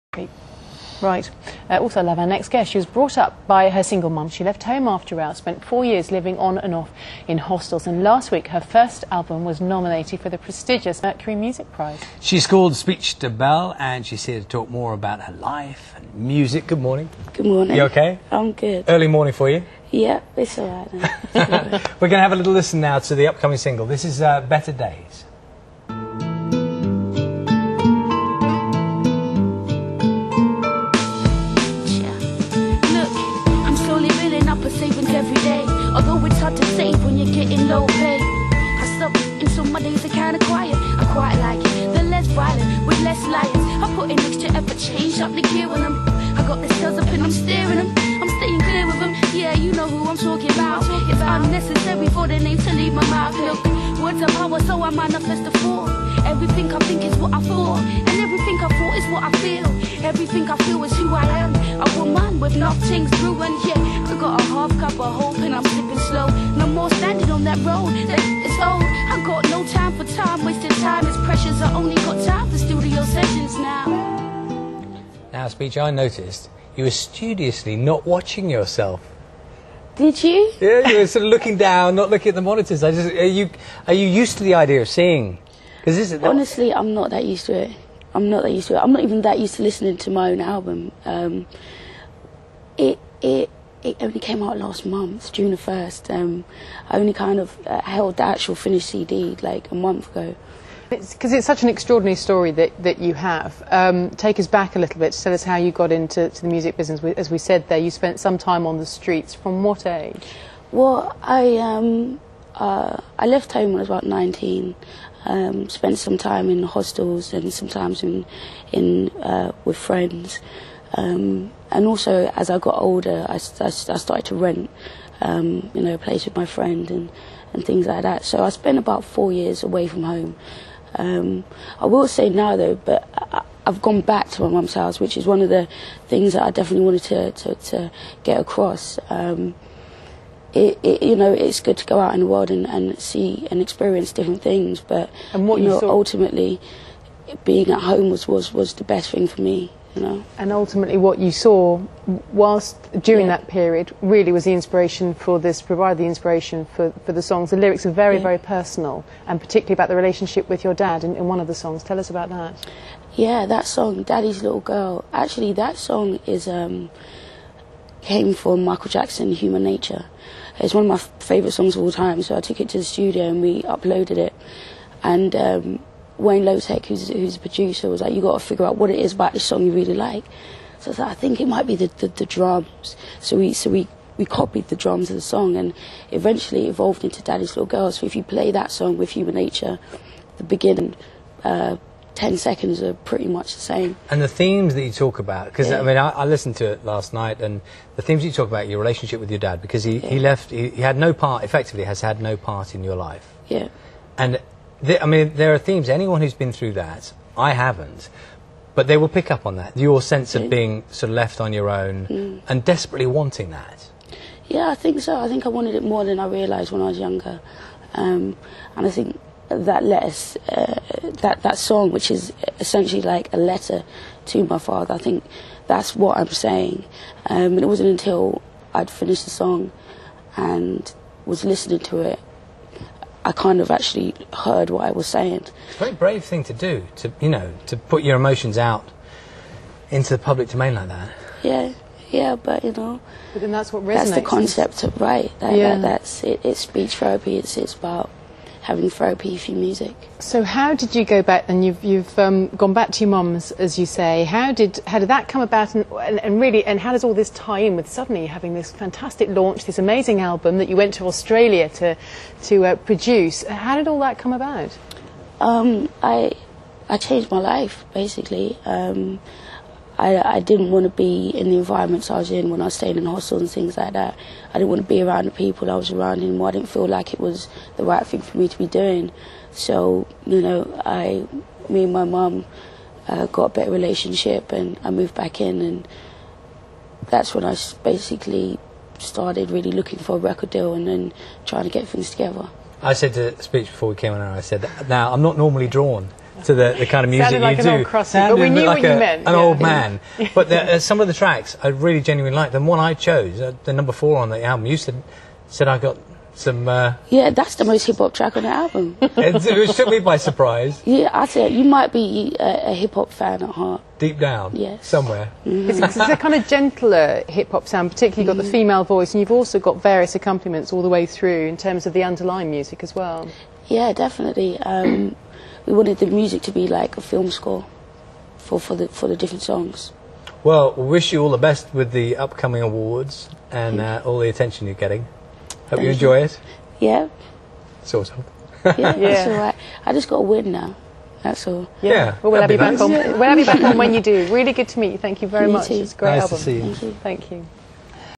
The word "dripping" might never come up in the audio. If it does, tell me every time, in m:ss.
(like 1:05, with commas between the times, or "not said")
not said.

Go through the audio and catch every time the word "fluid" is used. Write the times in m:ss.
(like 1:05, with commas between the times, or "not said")
not said.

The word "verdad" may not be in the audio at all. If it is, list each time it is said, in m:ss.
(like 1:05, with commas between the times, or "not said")
not said.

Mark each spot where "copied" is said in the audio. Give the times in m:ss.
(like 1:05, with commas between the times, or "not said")
3:04.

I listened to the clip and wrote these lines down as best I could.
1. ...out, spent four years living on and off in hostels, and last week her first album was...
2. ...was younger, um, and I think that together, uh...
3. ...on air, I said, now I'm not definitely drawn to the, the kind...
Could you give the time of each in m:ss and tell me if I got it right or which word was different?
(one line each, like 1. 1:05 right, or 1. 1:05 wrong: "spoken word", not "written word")
1. 0:05 right
2. 3:36 wrong: "letter", not "together"
3. 4:54 wrong: "normally", not "definitely".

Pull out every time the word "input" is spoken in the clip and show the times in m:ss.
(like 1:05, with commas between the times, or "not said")
not said.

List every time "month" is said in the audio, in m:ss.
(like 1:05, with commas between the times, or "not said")
1:34, 1:39.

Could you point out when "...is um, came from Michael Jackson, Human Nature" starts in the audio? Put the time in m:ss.
2:46.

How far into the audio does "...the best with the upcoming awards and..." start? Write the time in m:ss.
5:31.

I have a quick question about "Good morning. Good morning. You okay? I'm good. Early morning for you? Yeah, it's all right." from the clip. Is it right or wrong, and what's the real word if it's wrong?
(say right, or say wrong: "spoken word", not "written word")
right.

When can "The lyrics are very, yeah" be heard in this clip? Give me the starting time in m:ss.
2:37.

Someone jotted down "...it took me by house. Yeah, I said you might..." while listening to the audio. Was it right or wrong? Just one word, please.
wrong.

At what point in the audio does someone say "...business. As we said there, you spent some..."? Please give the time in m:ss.
1:46.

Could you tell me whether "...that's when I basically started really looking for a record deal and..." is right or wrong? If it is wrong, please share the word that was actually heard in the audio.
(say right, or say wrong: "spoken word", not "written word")
right.